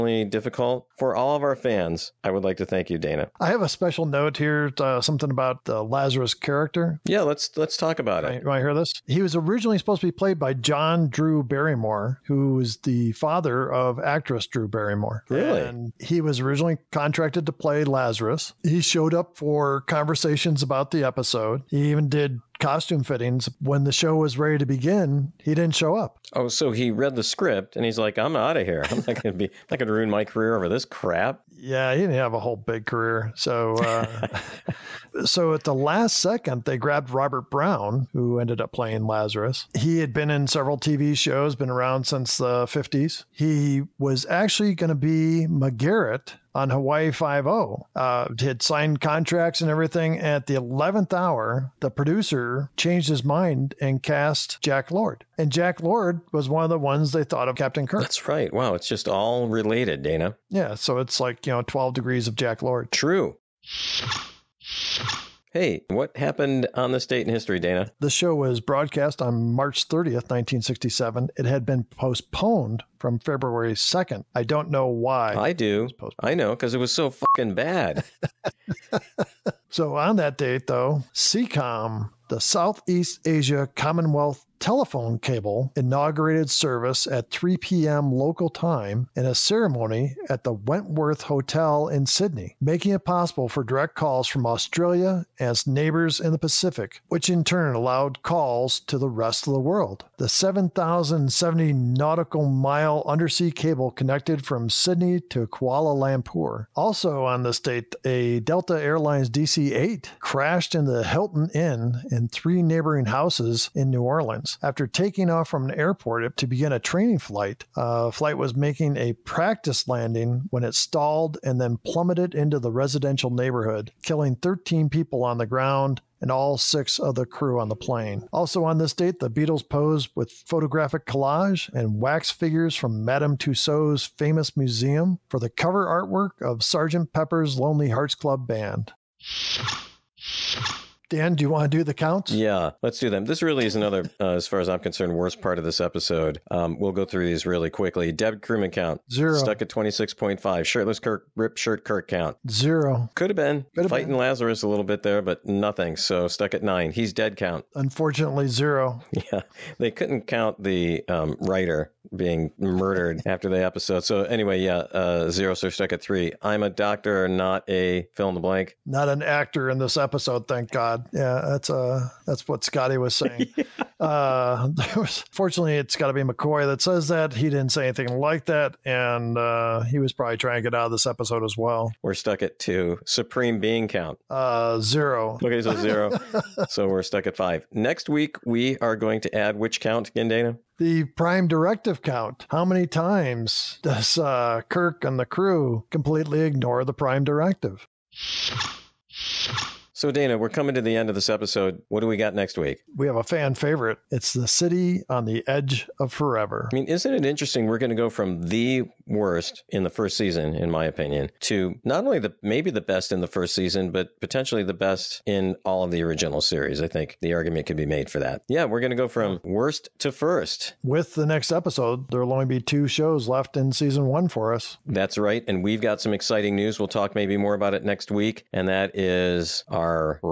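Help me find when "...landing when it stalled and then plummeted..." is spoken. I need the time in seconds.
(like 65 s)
119 s.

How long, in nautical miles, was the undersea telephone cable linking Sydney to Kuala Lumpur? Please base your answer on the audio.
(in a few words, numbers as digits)
7,070.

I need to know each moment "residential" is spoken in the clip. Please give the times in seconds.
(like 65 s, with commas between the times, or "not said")
122 s.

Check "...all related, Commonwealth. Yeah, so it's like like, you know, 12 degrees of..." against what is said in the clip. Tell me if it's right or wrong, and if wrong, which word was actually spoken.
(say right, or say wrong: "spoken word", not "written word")
wrong: "Dana", not "Commonwealth".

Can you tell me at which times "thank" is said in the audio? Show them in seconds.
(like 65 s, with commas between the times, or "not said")
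2 s, 170 s.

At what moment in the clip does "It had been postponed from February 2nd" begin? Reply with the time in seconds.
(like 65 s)
71 s.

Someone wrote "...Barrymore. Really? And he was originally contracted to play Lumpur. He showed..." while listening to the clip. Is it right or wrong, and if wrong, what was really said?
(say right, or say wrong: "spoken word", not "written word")
wrong: "Lazarus", not "Lumpur".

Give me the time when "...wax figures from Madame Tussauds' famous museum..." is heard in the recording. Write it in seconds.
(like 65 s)
131 s.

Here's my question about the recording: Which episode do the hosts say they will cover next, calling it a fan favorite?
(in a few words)
The City on the Edge of Forever.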